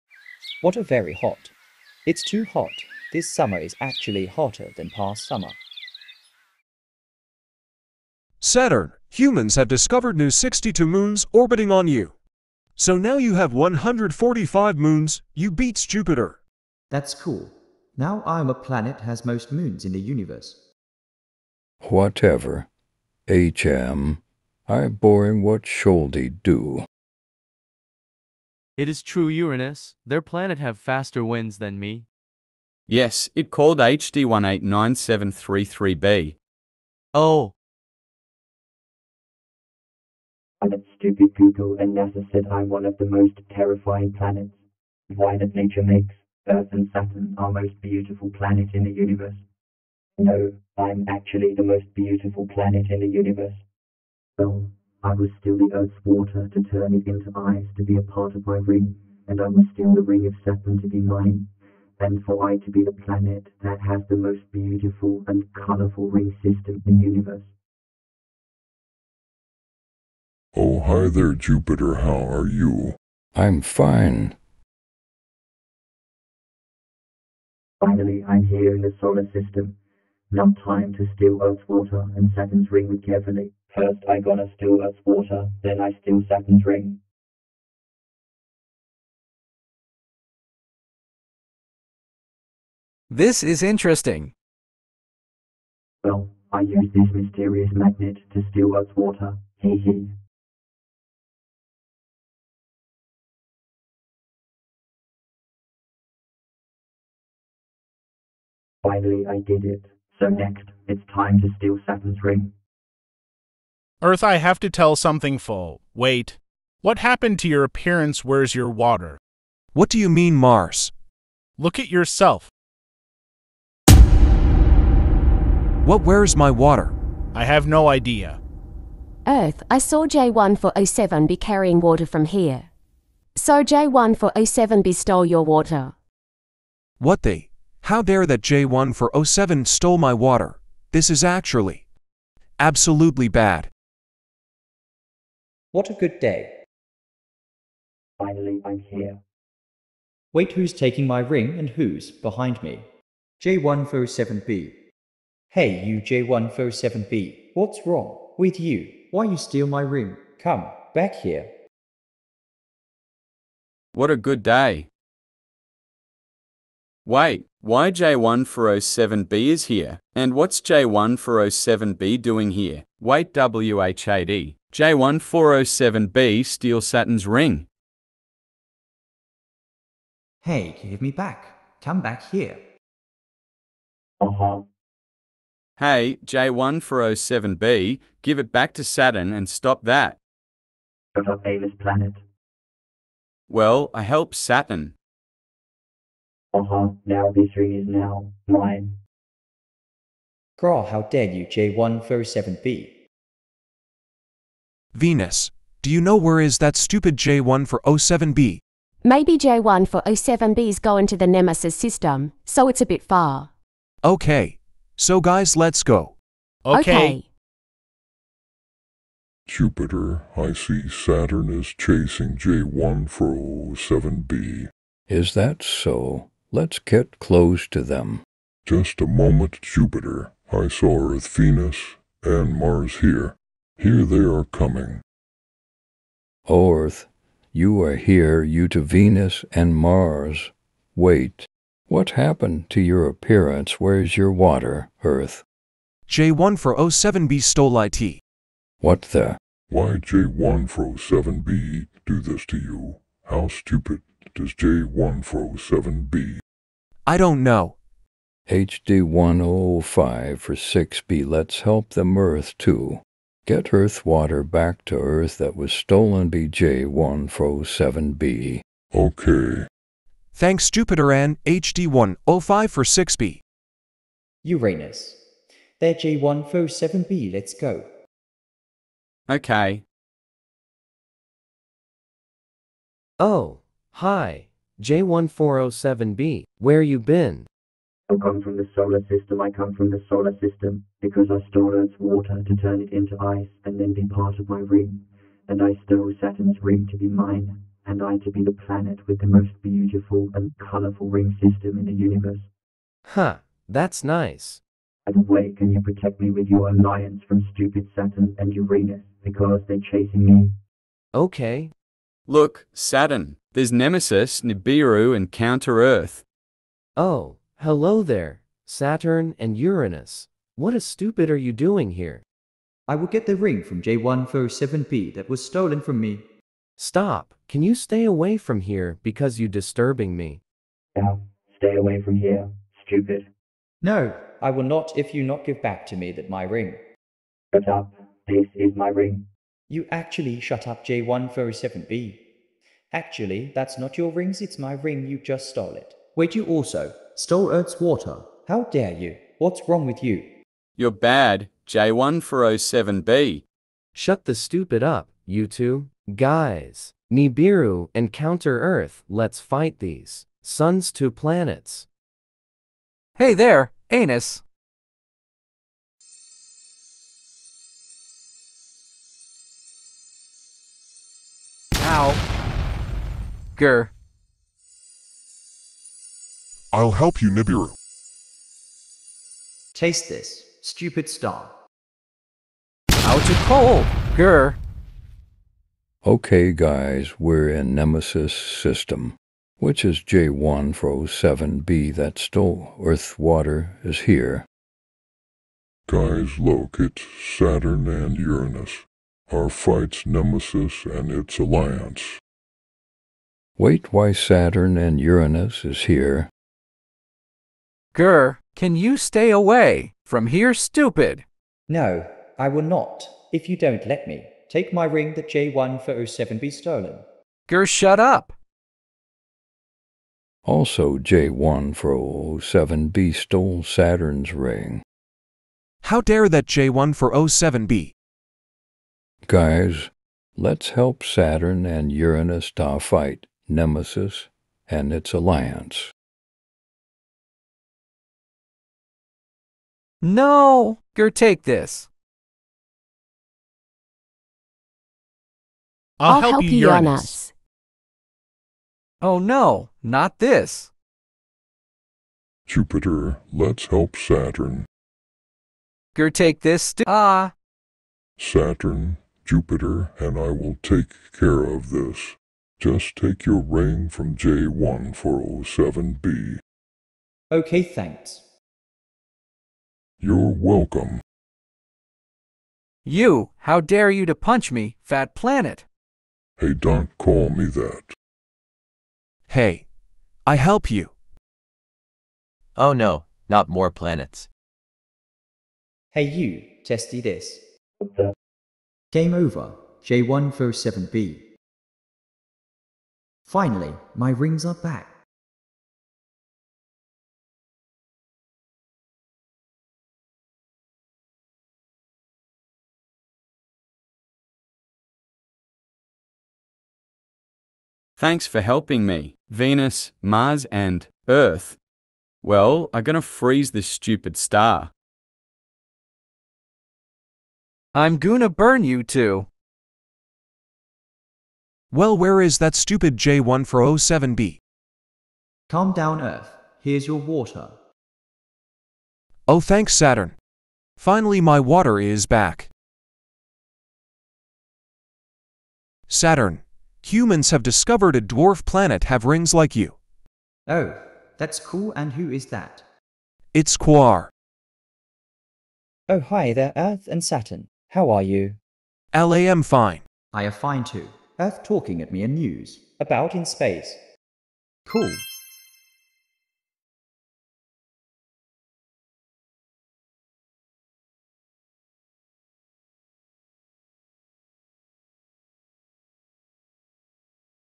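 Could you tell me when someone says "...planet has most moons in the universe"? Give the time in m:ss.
0:18.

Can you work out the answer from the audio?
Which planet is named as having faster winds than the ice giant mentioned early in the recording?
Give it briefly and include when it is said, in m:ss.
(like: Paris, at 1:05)
HD189733b, at 0:33.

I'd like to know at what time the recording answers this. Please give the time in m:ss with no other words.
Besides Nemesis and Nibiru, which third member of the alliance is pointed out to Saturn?
5:15.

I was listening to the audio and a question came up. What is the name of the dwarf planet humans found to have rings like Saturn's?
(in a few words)
Quaoar.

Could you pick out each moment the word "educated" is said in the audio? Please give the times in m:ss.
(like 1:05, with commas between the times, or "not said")
not said.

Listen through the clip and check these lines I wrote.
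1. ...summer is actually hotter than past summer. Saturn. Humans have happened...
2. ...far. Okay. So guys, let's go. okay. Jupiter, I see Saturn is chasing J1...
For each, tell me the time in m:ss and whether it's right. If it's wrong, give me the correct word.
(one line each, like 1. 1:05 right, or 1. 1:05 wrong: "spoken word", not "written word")
1. 0:03 wrong: "discovered", not "happened"
2. 3:33 right.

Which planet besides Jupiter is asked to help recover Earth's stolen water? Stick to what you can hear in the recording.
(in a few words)
HD 1056B.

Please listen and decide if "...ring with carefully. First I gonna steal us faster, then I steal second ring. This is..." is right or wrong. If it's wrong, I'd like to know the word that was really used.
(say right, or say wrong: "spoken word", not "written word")
wrong: "water", not "faster".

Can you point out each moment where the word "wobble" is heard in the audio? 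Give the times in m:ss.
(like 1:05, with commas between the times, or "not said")
not said.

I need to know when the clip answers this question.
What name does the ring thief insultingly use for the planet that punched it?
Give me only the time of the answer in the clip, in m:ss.
7:54.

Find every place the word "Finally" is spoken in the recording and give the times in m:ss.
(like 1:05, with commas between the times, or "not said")
1:17, 1:48, 2:28, 8:13, 8:50.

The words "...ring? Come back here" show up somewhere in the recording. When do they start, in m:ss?
2:39.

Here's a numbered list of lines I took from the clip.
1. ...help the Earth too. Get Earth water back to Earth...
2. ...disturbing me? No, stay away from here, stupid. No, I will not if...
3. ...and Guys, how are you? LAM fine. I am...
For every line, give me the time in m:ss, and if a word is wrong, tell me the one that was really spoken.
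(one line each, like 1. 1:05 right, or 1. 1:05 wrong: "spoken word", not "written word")
1. 4:21 right
2. 5:29 right
3. 9:06 wrong: "Saturn", not "Guys".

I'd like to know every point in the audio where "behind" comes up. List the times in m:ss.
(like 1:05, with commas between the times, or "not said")
2:32.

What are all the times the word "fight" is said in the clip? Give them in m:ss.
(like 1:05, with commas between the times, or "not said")
5:59, 6:39, 7:12.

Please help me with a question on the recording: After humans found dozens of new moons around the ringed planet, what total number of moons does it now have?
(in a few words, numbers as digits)
145.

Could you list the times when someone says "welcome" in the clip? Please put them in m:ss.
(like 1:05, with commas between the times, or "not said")
7:50.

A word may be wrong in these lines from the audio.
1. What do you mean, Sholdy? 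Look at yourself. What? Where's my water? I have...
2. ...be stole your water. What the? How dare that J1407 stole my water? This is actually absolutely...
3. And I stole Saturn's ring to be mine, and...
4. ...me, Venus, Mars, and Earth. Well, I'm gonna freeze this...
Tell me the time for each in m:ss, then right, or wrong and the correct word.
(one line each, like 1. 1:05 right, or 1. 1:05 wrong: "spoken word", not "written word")
1. 1:59 wrong: "Mars", not "Sholdy"
2. 2:14 right
3. 4:55 right
4. 8:28 right.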